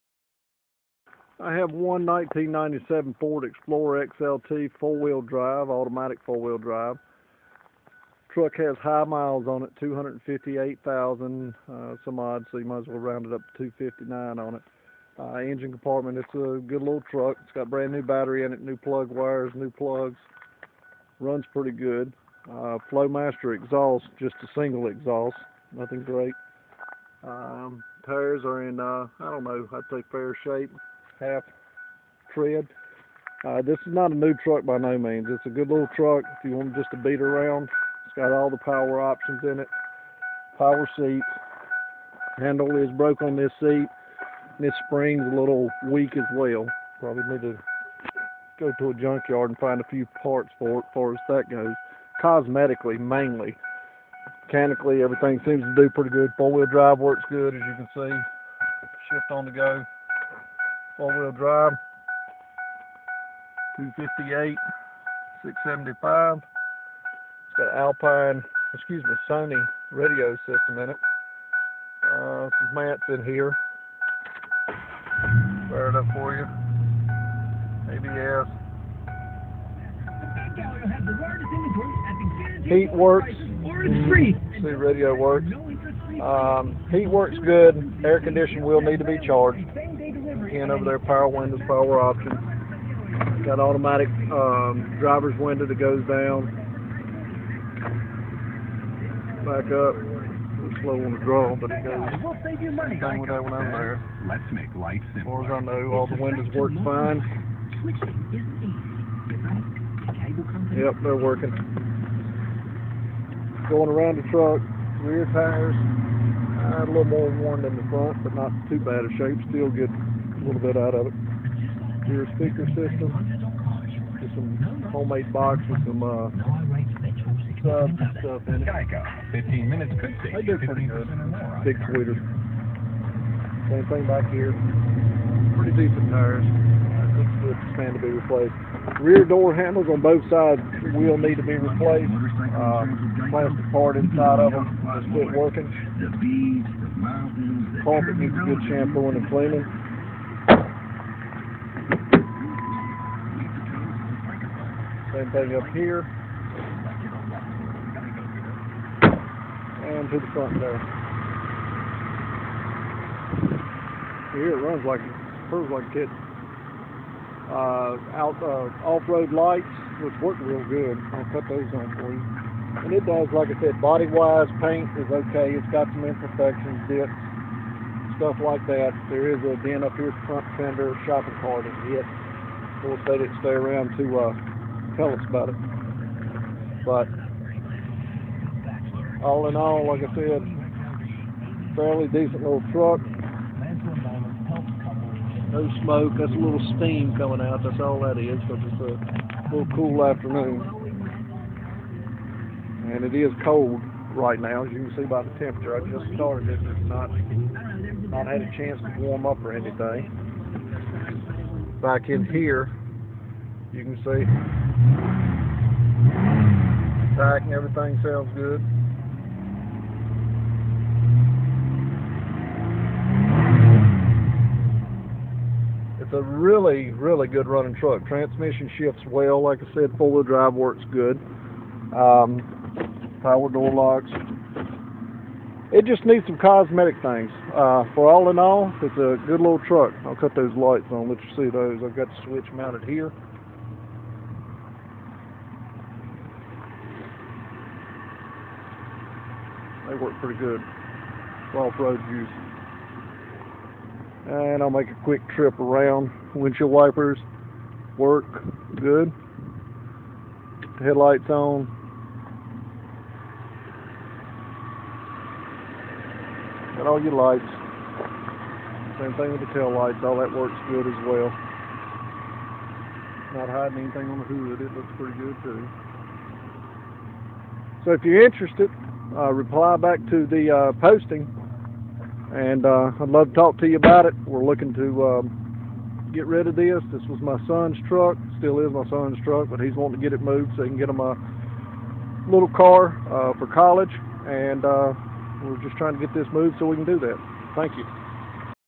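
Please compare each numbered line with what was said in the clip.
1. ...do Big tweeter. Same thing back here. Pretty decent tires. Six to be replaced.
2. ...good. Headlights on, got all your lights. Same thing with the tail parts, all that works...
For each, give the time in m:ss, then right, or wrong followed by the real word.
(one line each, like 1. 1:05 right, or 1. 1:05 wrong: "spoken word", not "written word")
1. 2:10 right
2. 4:18 wrong: "lights", not "parts".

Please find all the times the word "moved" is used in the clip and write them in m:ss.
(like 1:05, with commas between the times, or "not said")
4:50, 4:56.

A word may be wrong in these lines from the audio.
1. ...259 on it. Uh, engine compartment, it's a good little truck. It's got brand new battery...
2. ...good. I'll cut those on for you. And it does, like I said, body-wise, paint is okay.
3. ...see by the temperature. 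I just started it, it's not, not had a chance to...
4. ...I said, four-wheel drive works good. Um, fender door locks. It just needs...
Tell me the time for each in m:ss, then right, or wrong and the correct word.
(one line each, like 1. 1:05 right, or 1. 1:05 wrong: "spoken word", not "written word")
1. 0:13 right
2. 2:50 right
3. 3:24 right
4. 3:49 wrong: "power", not "fender".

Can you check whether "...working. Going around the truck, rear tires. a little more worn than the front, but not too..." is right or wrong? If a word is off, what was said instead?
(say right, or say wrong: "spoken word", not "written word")
right.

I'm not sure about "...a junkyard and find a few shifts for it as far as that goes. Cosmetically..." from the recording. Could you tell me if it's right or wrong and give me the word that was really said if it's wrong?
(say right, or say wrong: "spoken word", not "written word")
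wrong: "parts", not "shifts".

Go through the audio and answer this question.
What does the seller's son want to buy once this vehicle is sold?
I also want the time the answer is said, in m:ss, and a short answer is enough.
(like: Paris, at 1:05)
A little car, at 4:52.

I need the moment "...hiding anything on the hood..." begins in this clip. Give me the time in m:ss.
4:33.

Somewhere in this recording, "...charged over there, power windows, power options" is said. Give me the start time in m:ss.
1:29.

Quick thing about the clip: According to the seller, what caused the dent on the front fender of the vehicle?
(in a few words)
Shopping cart.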